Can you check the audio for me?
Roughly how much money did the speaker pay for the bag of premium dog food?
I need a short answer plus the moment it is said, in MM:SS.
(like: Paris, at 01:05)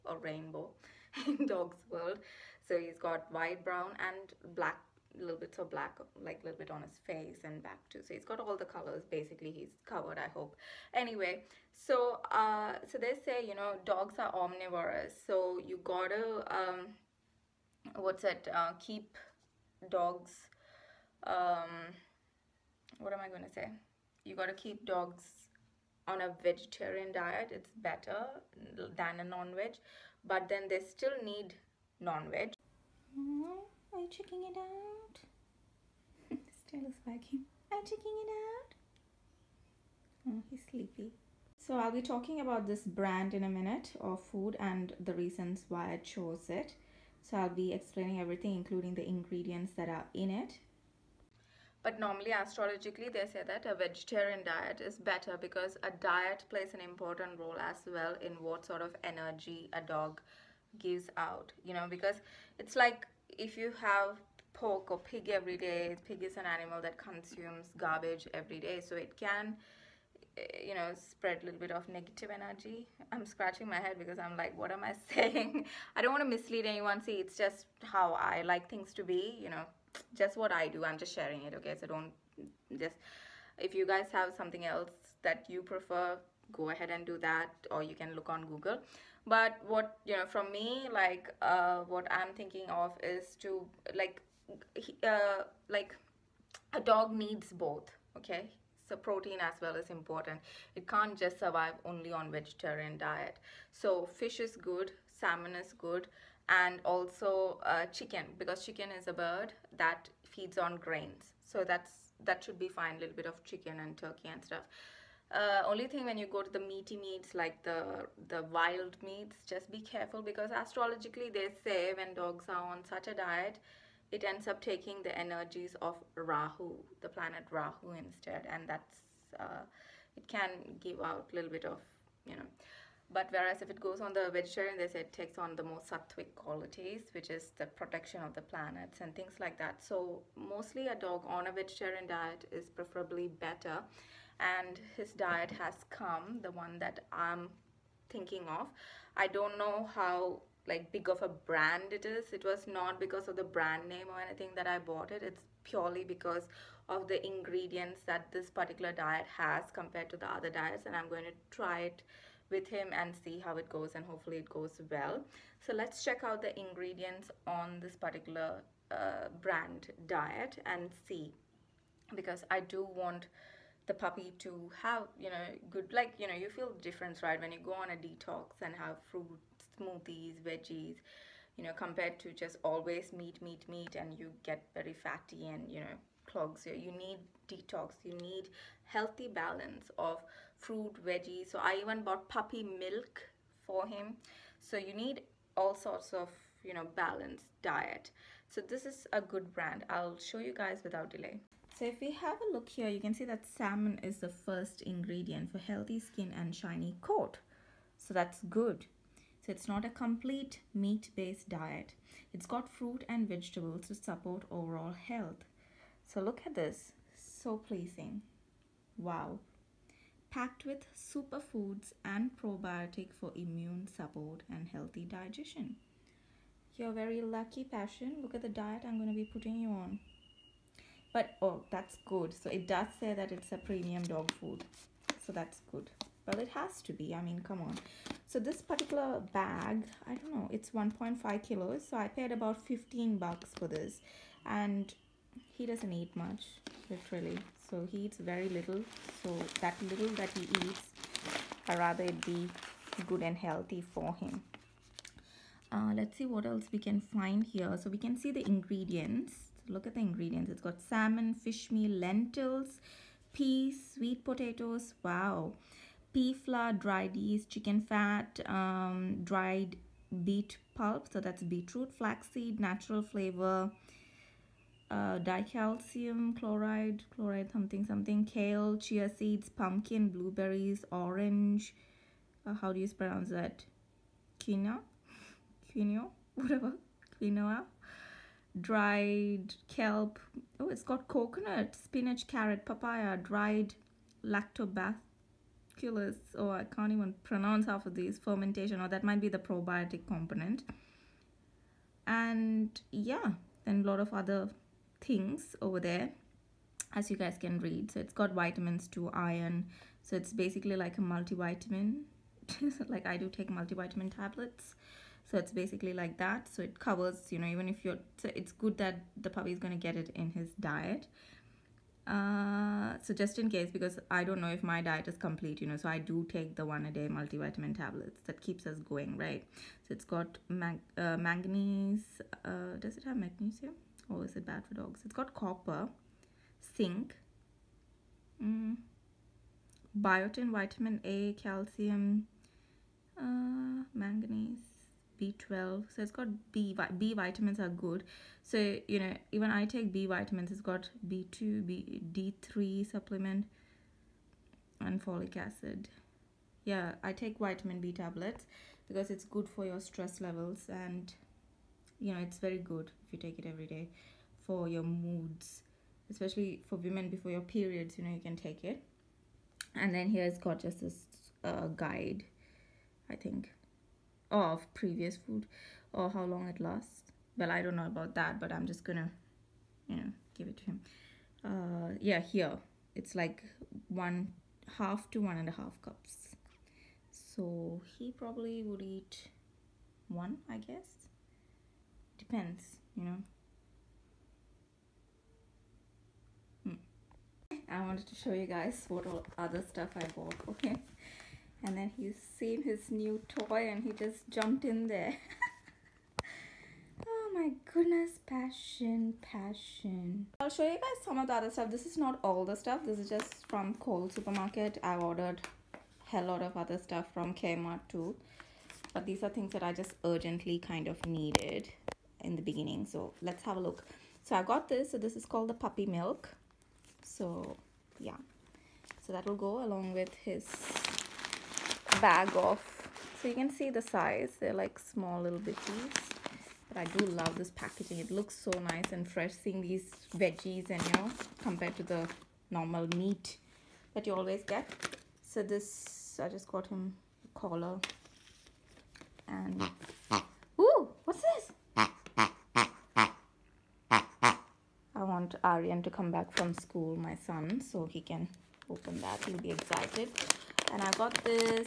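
15 bucks, at 04:02.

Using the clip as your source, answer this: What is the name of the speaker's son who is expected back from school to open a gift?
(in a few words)
Aryan.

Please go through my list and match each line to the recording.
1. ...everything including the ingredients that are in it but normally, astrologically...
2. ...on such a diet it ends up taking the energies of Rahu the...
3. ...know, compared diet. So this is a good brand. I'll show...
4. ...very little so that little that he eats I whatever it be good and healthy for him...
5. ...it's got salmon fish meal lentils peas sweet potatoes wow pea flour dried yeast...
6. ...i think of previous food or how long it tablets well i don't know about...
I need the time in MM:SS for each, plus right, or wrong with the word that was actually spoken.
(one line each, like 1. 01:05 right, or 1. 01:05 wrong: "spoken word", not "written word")
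1. 00:48 right
2. 02:02 right
3. 03:16 wrong: "balanced", not "compared"
4. 04:08 wrong: "rather", not "whatever"
5. 04:20 right
6. 06:13 wrong: "lasts", not "tablets".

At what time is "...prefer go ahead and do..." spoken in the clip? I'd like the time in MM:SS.
01:25.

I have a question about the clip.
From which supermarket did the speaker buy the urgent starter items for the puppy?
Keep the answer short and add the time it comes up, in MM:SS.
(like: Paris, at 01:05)
Coles, at 06:53.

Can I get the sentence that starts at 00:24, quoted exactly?
You got to keep dogs on a vegetarian diet.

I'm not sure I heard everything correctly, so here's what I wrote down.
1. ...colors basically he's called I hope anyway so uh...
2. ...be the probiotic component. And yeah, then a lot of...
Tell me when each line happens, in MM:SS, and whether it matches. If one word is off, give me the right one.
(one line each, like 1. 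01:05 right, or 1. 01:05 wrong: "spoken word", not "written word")
1. 00:08 wrong: "covered", not "called"
2. 04:59 right.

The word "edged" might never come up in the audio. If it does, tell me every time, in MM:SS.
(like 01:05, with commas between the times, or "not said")
not said.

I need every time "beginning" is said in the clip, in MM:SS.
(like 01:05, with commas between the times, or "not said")
07:02.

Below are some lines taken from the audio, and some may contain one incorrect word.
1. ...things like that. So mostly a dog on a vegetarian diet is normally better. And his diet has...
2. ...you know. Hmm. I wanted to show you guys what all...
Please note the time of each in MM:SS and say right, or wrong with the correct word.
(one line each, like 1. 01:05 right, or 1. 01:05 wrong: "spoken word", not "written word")
1. 02:19 wrong: "preferably", not "normally"
2. 06:32 right.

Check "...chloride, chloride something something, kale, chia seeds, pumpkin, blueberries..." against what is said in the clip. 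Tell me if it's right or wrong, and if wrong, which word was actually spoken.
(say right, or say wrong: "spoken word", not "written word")
right.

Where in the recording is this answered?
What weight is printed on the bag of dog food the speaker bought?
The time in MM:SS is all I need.
04:00.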